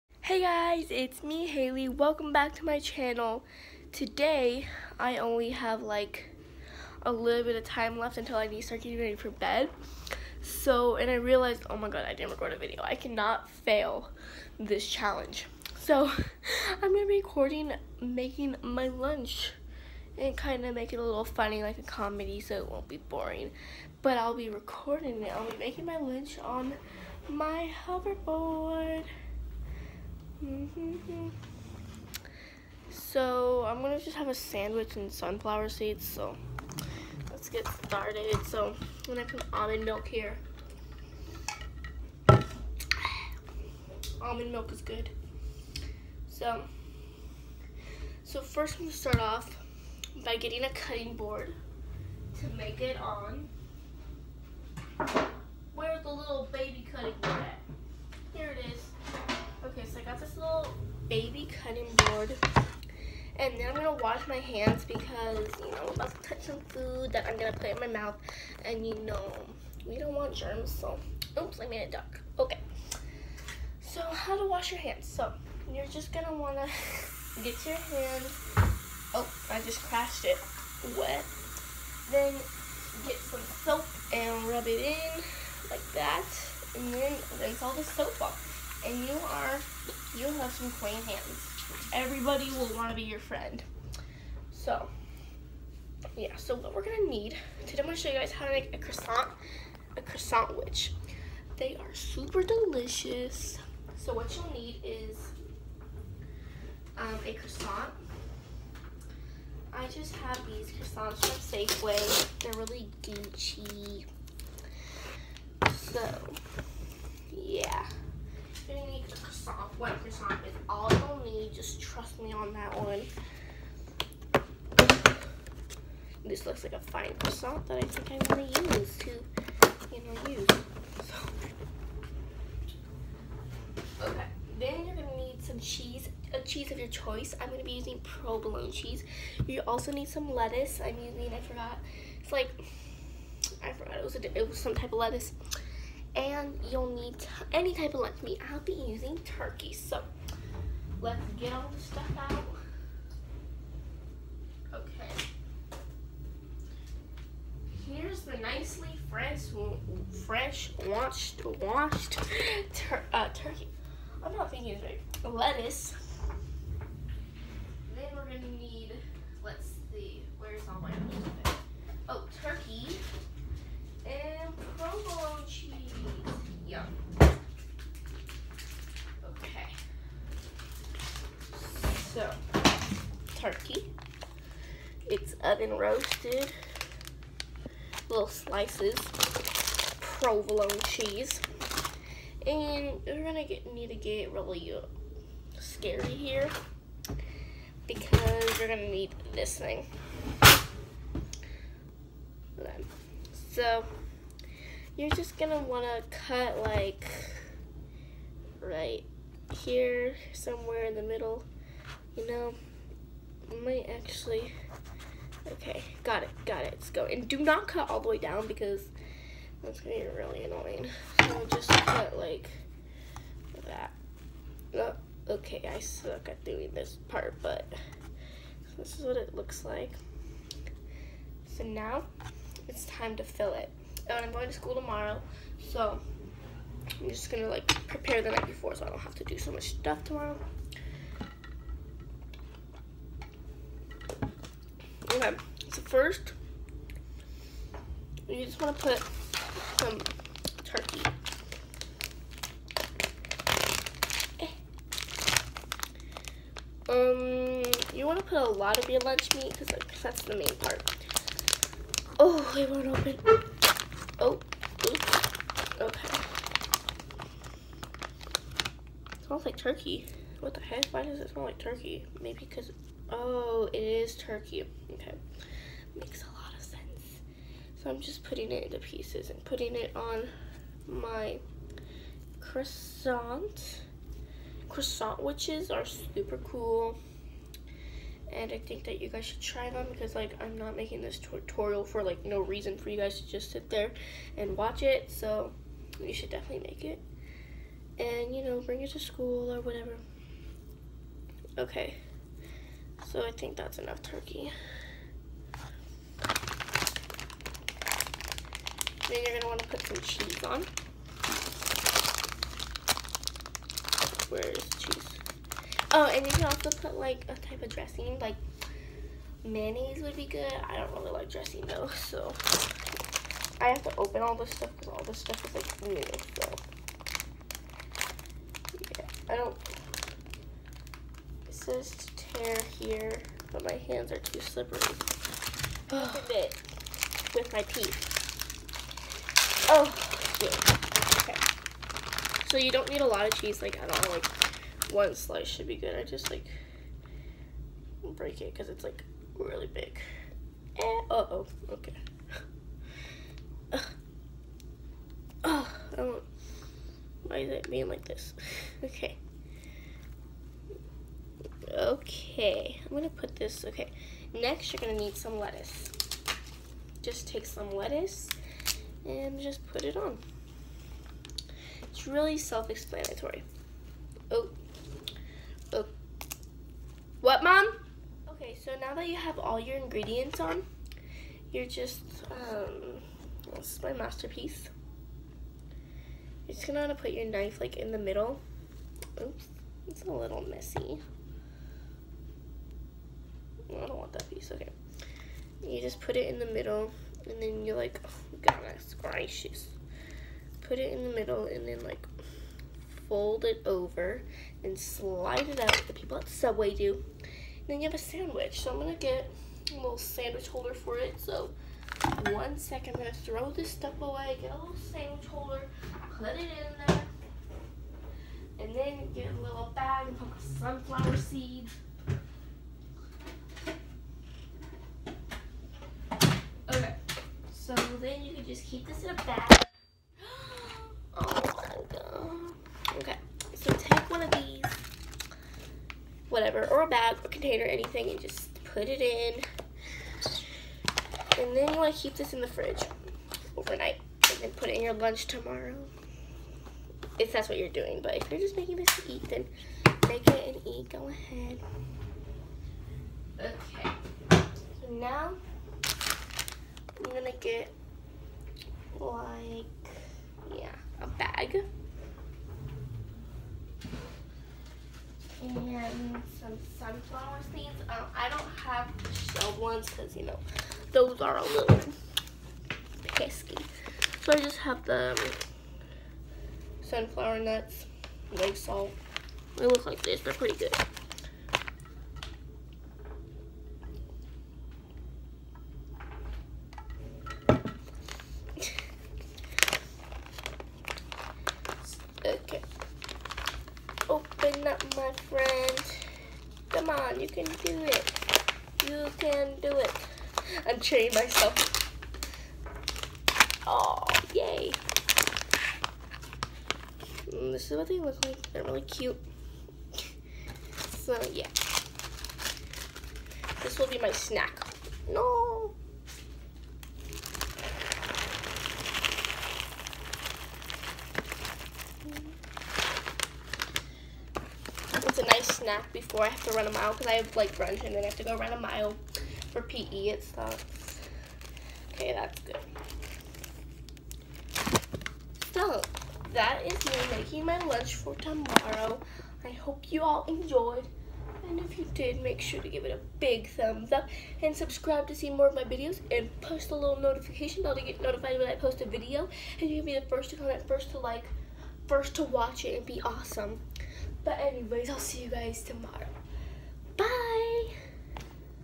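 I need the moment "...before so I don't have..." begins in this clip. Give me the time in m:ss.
3:58.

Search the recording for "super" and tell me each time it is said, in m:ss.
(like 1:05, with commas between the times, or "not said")
1:41, 4:45.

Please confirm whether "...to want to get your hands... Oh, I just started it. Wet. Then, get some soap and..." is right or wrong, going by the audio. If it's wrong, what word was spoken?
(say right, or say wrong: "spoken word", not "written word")
wrong: "crashed", not "started".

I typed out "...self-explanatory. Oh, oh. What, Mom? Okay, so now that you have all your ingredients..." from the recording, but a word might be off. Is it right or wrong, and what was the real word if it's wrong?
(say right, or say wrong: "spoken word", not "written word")
right.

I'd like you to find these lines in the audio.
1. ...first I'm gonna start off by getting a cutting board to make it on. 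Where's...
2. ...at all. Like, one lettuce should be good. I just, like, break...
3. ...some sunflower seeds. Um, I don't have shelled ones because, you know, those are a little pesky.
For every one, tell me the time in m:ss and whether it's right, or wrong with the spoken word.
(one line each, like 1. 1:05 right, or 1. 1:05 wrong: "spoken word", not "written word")
1. 0:48 right
2. 5:43 wrong: "slice", not "lettuce"
3. 7:46 right.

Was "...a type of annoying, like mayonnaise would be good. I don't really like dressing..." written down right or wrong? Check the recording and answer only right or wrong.
wrong.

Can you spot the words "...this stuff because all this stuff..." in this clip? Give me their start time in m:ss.
5:24.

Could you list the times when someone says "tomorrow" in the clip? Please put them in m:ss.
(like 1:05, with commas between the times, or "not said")
3:54, 4:00, 7:25, 8:58, 9:15.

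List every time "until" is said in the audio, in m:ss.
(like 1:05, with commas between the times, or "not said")
0:08.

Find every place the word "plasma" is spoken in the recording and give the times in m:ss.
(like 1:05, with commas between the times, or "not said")
not said.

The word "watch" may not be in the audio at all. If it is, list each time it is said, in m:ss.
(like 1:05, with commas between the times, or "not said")
4:54, 9:12.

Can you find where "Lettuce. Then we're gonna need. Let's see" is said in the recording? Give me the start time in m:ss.
2:45.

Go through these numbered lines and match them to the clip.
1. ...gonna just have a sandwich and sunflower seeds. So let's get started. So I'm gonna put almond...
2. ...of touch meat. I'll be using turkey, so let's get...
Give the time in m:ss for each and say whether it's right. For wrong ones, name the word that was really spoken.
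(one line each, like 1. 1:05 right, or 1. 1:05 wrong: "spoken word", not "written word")
1. 0:33 right
2. 2:27 wrong: "lunch", not "touch".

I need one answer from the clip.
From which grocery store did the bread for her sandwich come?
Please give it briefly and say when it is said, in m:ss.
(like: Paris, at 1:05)
Safeway, at 1:51.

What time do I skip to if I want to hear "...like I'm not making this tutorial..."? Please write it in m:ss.
4:50.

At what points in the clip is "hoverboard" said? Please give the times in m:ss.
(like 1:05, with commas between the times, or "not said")
0:27.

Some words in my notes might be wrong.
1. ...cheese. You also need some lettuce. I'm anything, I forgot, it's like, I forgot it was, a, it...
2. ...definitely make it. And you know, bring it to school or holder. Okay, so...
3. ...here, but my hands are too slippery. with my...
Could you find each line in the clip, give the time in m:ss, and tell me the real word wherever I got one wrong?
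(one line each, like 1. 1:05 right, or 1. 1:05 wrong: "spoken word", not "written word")
1. 2:18 wrong: "using", not "anything"
2. 4:56 wrong: "whatever", not "holder"
3. 5:32 right.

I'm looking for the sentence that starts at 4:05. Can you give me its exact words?
Okay, so first, you just want to put some turkey.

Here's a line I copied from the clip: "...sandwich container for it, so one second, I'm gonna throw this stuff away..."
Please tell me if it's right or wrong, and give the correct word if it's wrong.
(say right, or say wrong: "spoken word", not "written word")
wrong: "holder", not "container".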